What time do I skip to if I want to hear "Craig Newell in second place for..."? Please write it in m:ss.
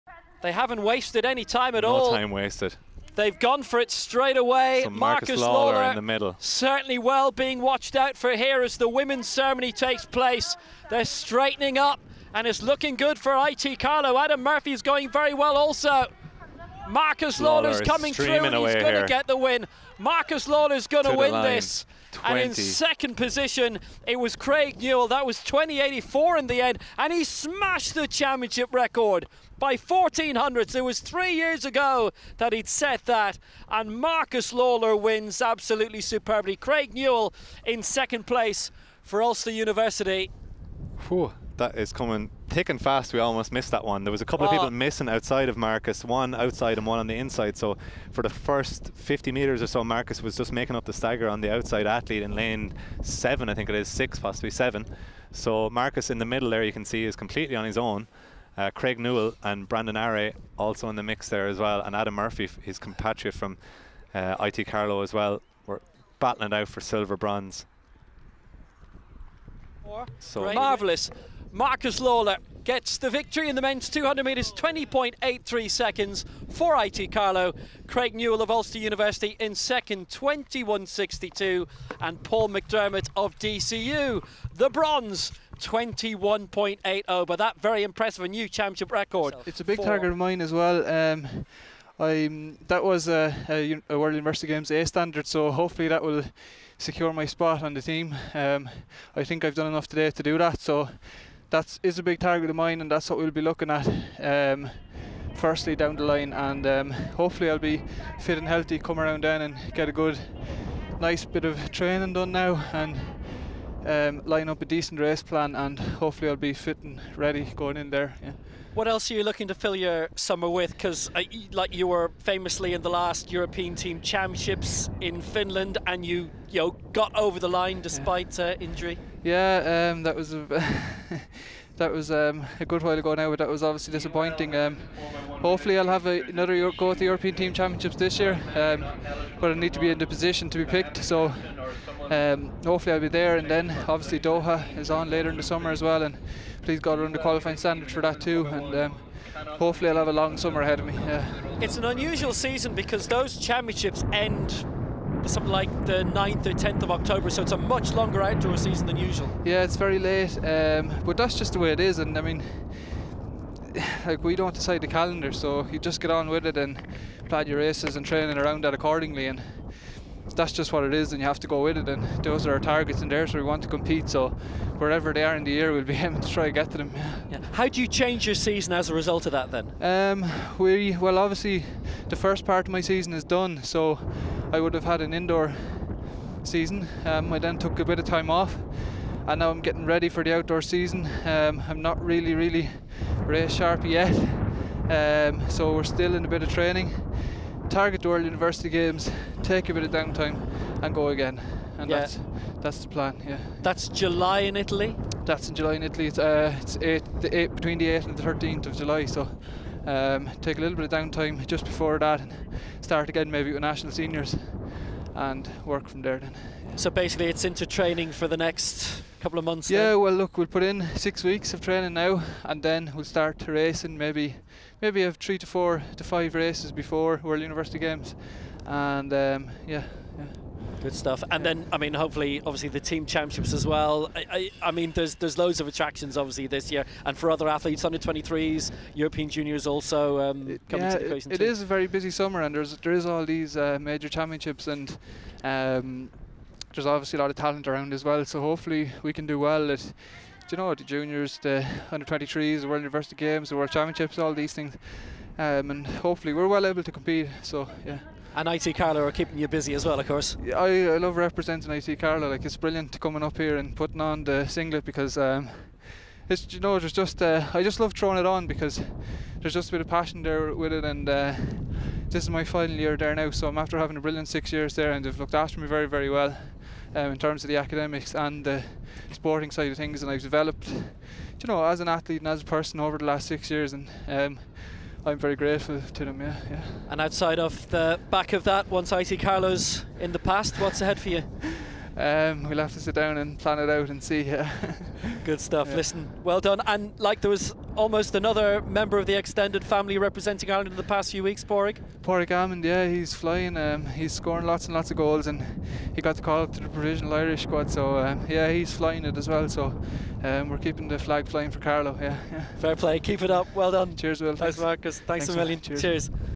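0:36.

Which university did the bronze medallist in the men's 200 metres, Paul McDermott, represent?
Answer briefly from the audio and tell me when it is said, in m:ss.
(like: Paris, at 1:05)
DCU, at 1:23.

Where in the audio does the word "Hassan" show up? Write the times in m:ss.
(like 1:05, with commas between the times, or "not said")
not said.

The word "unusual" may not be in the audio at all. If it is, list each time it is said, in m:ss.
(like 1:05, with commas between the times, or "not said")
2:31.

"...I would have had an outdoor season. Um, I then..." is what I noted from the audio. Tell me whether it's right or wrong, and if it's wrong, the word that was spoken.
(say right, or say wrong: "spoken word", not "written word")
wrong: "indoor", not "outdoor".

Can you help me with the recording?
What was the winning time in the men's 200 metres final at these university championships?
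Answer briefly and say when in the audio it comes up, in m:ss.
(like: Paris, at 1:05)
20.83 seconds, at 1:14.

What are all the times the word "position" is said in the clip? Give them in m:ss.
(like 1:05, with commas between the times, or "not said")
0:23, 2:20.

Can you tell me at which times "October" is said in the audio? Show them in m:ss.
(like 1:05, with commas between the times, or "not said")
2:36.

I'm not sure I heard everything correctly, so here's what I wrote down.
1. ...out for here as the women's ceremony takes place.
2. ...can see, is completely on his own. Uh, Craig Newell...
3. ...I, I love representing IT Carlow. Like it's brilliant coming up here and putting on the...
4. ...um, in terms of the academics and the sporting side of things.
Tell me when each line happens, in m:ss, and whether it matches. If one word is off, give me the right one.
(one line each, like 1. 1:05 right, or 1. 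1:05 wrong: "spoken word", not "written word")
1. 0:07 right
2. 0:56 right
3. 4:20 right
4. 4:36 right.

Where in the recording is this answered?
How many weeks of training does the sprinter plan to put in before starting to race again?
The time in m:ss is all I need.
3:40.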